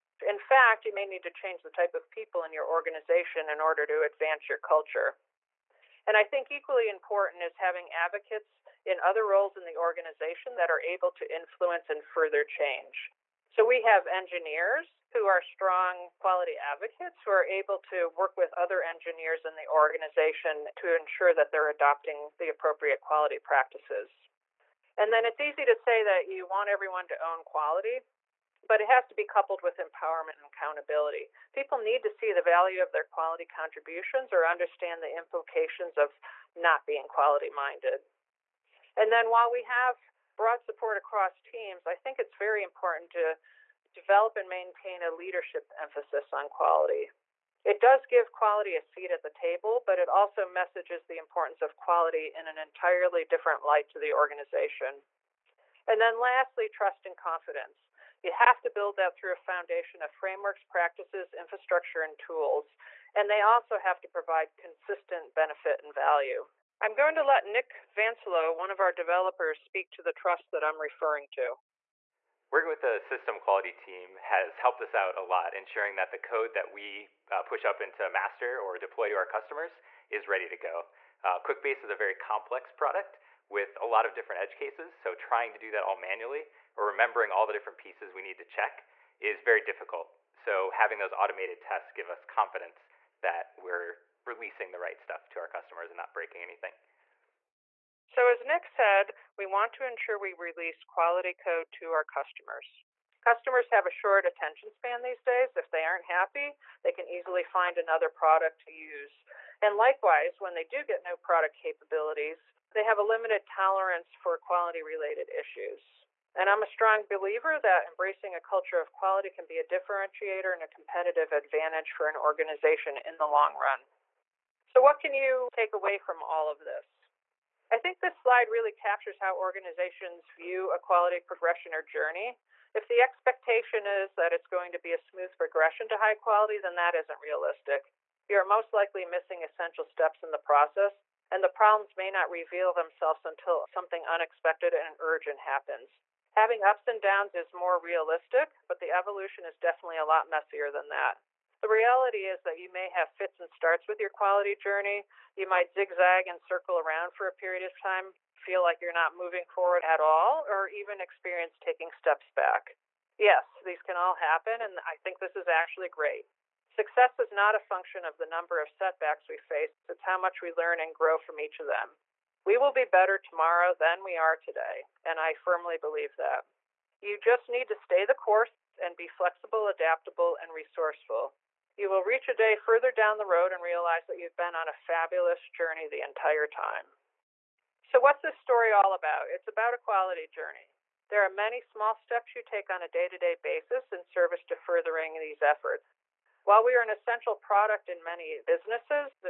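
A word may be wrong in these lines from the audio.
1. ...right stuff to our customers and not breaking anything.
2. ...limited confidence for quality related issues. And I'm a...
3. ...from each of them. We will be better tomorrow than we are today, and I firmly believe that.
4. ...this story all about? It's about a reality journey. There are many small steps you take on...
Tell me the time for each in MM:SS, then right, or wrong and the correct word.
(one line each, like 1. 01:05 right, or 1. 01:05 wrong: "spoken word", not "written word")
1. 01:34 right
2. 01:53 wrong: "tolerance", not "confidence"
3. 02:51 right
4. 03:08 wrong: "quality", not "reality".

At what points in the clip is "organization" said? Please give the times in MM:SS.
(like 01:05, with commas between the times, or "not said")
00:02, 00:09, 00:19, 00:54, 02:02, 02:09.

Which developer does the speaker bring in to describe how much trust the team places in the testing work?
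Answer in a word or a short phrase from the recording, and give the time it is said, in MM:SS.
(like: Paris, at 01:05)
Nick Vansilo, at 01:07.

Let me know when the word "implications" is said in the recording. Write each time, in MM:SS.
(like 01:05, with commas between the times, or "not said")
00:35.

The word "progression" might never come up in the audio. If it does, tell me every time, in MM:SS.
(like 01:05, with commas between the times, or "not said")
02:11, 02:15.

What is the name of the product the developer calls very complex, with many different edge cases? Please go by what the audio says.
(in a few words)
QuickBase.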